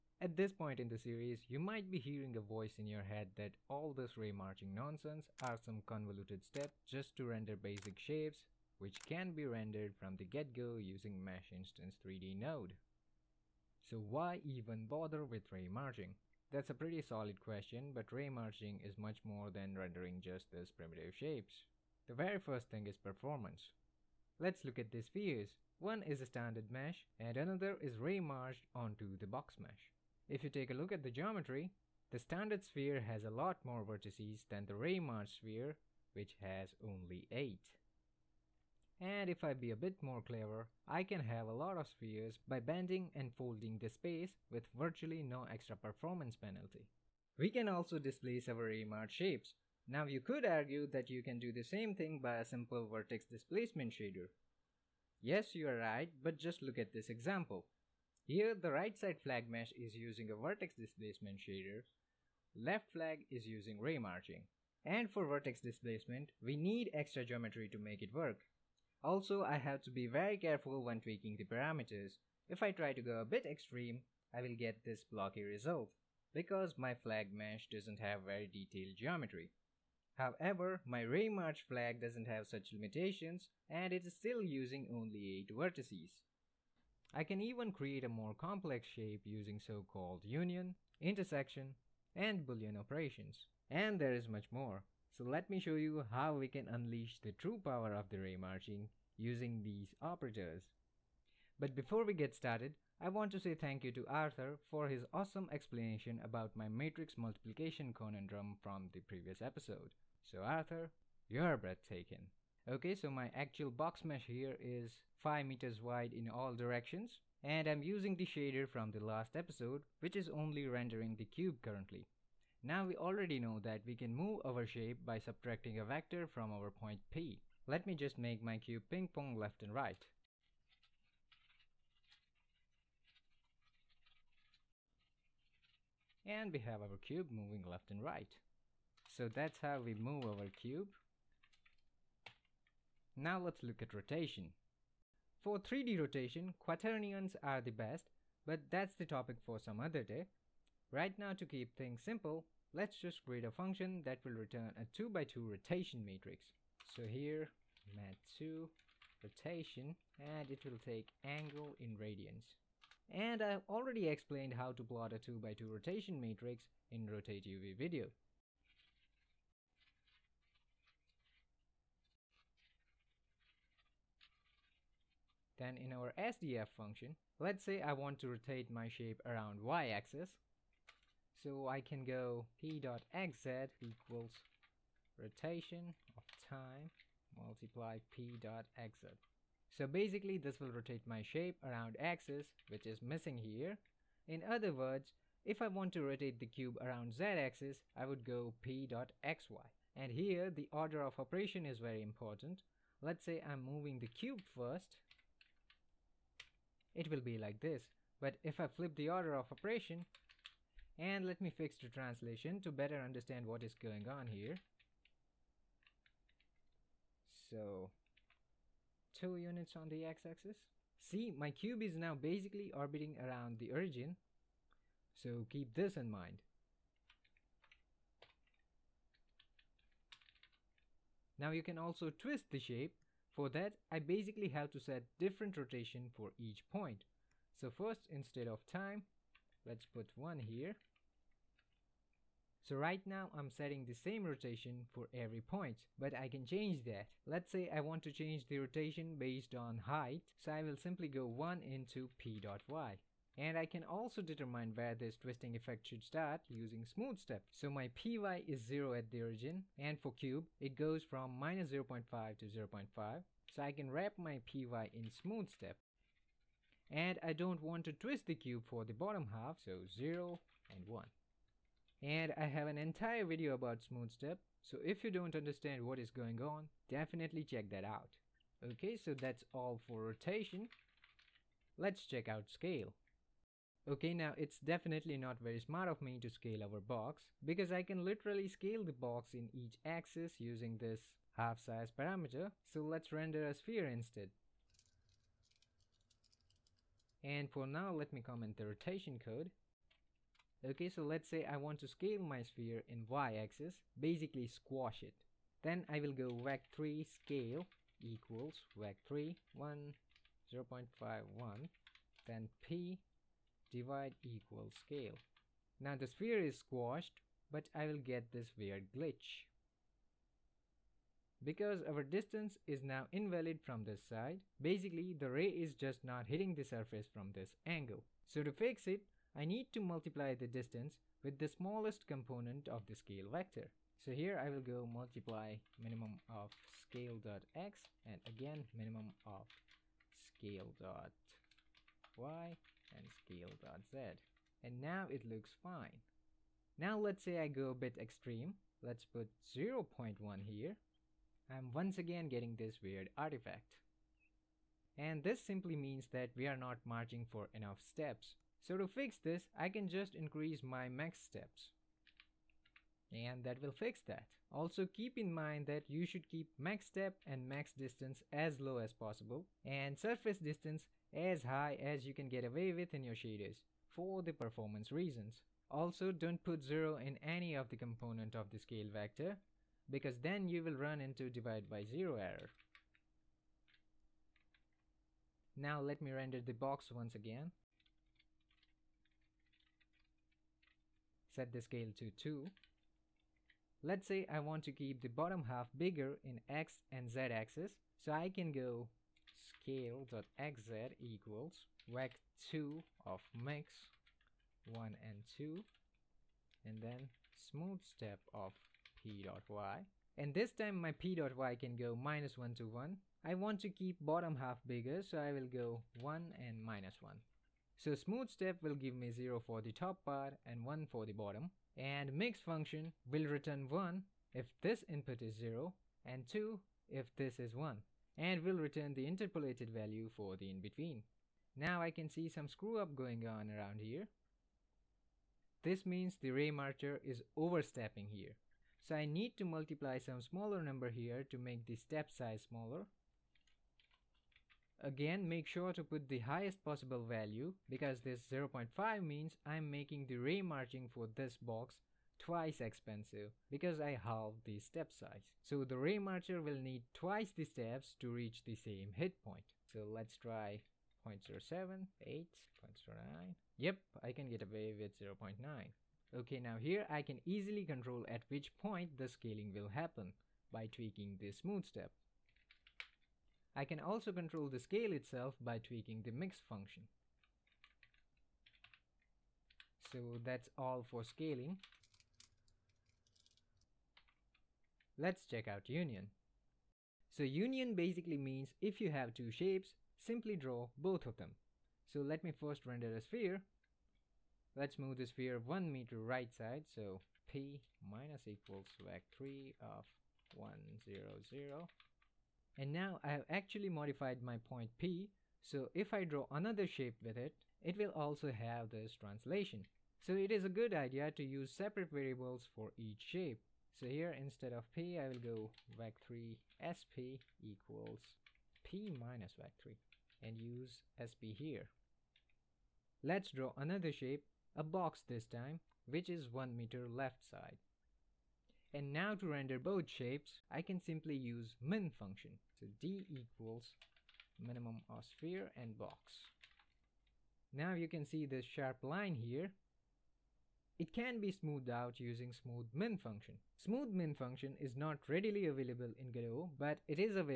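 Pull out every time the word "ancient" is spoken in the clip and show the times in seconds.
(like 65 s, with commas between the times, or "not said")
not said.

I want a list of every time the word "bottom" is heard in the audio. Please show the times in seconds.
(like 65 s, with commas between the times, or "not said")
268 s, 395 s, 414 s, 421 s.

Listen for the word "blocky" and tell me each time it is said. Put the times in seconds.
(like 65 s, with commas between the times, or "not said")
75 s.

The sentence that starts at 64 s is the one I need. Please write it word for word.
And for vertex displacement, we need extra geometry to make it work.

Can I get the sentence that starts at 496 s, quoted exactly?
So P minus equals vec3 of 1, 0, 0.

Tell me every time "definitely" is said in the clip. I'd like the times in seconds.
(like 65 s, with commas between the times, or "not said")
276 s, 284 s.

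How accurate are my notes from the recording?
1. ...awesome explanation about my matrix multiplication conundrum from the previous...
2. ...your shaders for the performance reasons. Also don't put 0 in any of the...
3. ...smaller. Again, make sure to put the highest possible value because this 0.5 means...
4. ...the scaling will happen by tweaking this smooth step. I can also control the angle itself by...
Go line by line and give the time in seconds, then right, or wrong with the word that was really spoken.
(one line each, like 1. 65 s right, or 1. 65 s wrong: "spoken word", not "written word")
1. 105 s right
2. 373 s right
3. 442 s right
4. 468 s wrong: "scale", not "angle".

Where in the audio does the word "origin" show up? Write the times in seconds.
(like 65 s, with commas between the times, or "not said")
223 s, 259 s.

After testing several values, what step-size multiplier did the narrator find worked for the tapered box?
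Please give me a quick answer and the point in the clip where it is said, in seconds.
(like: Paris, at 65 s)
0.9, at 464 s.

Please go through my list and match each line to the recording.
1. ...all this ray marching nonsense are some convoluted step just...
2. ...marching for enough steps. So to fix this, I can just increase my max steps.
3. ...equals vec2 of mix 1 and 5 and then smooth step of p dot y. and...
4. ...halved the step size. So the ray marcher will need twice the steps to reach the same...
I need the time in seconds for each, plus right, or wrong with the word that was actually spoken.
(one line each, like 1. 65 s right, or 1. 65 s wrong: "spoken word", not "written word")
1. 3 s right
2. 356 s right
3. 400 s wrong: "2", not "5"
4. 453 s right.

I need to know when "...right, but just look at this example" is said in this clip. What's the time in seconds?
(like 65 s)
55 s.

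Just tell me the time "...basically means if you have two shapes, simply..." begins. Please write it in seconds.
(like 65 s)
487 s.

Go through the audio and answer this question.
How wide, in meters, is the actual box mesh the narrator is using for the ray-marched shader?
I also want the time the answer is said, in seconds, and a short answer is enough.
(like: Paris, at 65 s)
5 meters, at 115 s.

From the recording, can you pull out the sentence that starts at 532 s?
So D equals minimum of sphere and box.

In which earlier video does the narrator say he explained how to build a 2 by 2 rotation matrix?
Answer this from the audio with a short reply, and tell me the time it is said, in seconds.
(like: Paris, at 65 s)
Rotate UV, at 167 s.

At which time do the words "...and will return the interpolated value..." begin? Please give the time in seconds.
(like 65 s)
428 s.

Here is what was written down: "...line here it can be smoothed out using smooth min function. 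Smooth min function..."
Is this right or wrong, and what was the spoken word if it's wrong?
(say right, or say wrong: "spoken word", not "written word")
right.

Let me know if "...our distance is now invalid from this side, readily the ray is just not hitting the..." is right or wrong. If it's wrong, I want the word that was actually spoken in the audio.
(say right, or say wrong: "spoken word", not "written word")
wrong: "basically", not "readily".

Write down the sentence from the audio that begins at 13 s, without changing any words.
So why even bother with ray marching?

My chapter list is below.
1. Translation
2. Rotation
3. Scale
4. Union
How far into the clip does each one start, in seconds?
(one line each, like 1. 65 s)
1. 120 s
2. 143 s
3. 282 s
4. 485 s.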